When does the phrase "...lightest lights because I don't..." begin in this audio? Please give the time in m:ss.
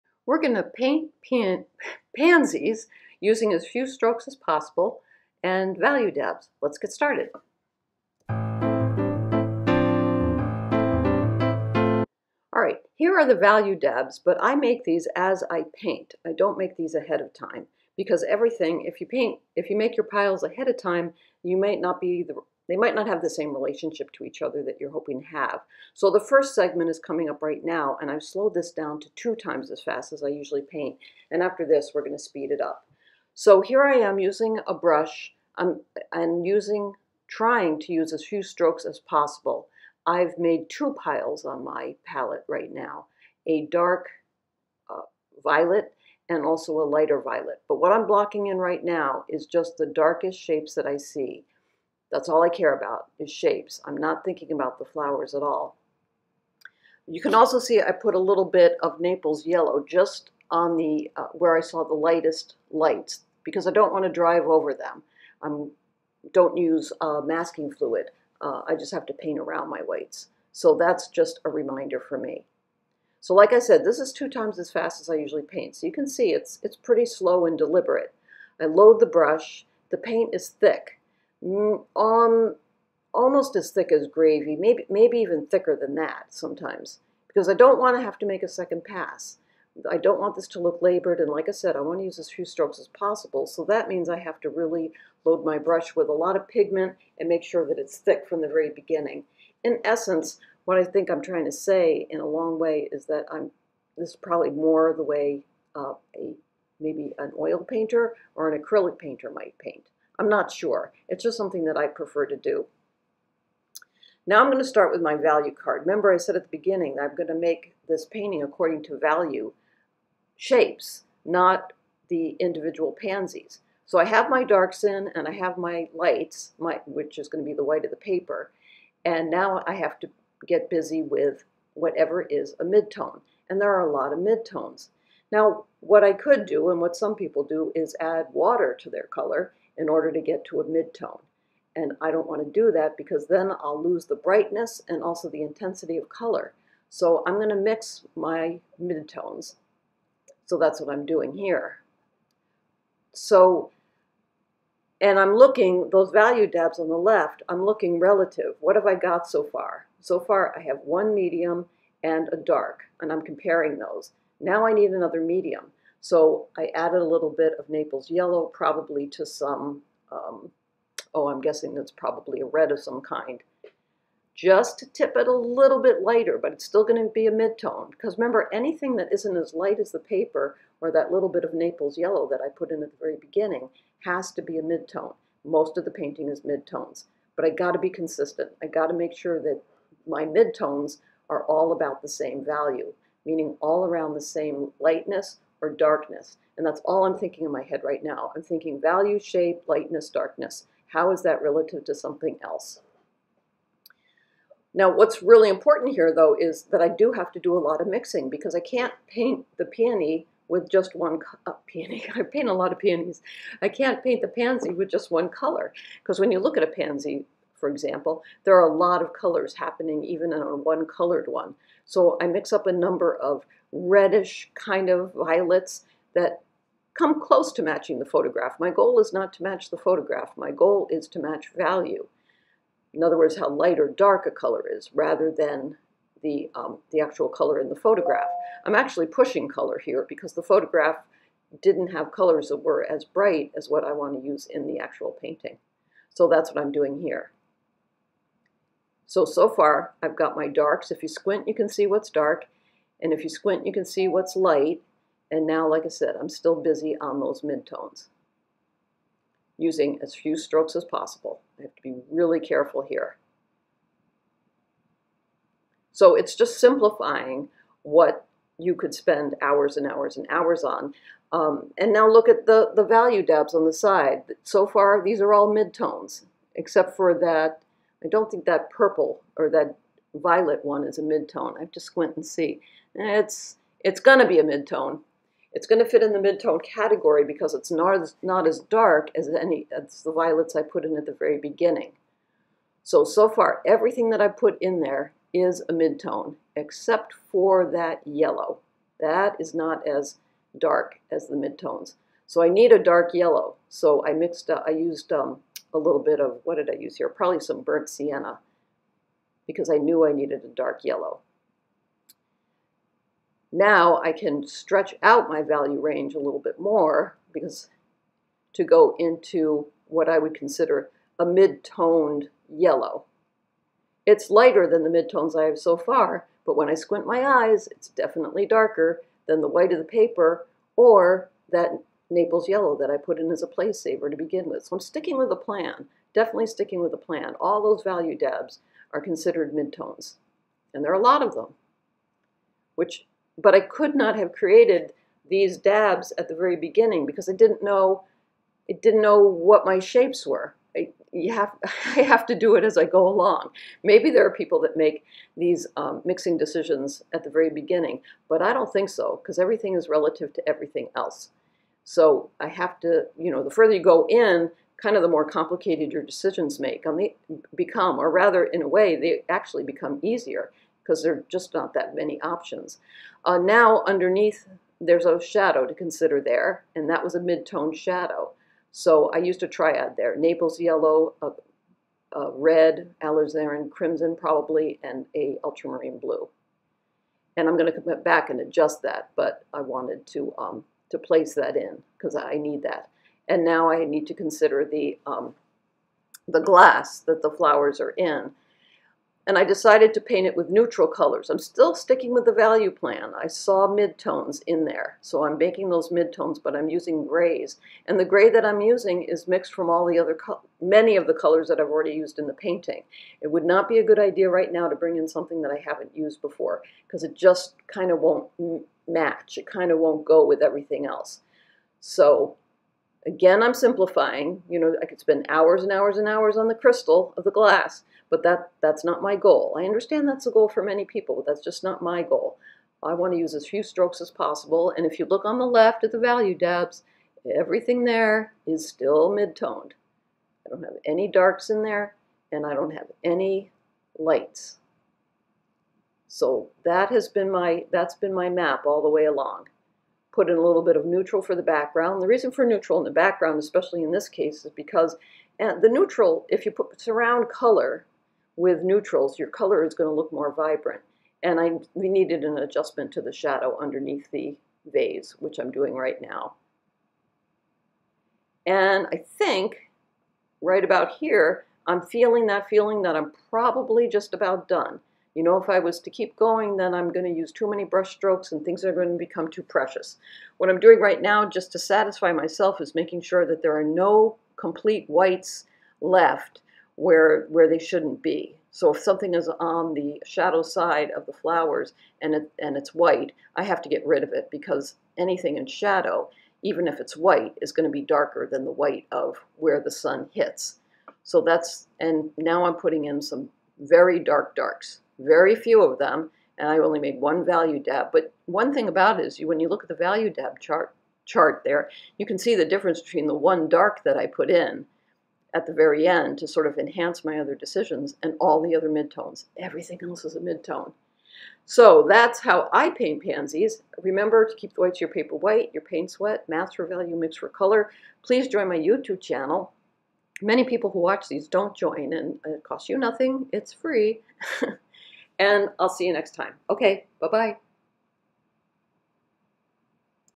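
1:01.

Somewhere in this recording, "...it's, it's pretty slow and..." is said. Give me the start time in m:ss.
1:16.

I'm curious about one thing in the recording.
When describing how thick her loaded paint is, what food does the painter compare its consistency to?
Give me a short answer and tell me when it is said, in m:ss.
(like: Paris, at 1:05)
gravy, at 1:24.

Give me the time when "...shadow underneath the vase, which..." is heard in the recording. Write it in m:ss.
7:43.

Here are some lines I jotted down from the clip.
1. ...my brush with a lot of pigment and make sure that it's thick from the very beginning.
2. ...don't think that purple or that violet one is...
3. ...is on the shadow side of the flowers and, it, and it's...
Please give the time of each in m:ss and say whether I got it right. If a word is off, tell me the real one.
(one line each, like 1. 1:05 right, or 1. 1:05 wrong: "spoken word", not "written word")
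1. 1:35 right
2. 4:38 right
3. 8:09 right.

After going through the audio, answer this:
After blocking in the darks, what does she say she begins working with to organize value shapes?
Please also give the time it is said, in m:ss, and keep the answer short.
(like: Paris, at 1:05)
value card, at 1:55.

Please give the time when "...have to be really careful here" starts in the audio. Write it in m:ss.
4:21.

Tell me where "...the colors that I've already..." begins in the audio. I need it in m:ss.
6:51.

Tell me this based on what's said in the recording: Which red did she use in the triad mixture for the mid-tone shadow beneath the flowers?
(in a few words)
alizarin crimson.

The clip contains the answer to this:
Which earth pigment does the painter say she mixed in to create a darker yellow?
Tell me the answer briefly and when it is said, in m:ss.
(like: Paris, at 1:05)
burnt sienna, at 5:07.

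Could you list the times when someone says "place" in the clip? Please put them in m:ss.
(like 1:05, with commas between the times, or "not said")
5:33, 6:30.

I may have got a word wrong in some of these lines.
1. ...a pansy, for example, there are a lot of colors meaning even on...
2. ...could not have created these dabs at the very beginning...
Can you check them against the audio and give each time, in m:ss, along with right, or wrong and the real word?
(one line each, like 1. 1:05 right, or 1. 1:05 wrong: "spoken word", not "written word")
1. 3:36 wrong: "happening", not "meaning"
2. 5:43 right.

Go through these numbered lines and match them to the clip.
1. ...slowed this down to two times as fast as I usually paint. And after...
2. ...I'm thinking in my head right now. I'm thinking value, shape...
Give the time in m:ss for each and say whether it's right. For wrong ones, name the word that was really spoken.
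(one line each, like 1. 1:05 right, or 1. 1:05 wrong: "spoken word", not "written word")
1. 0:28 right
2. 3:17 right.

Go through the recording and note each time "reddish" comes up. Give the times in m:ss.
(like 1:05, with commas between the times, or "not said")
3:43.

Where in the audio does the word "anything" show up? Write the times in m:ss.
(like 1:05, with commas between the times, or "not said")
2:58, 8:14.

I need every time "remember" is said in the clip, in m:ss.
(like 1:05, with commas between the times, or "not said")
1:55, 2:58, 8:43.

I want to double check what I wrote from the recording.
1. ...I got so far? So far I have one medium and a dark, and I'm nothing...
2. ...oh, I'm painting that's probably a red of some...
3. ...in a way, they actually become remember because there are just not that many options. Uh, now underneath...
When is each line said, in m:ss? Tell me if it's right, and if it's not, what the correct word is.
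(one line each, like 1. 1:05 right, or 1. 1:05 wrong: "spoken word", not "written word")
1. 2:38 wrong: "comparing", not "nothing"
2. 2:51 wrong: "guessing", not "painting"
3. 6:08 wrong: "easier", not "remember".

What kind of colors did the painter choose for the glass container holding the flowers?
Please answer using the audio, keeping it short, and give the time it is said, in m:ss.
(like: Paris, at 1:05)
neutral colors, at 6:40.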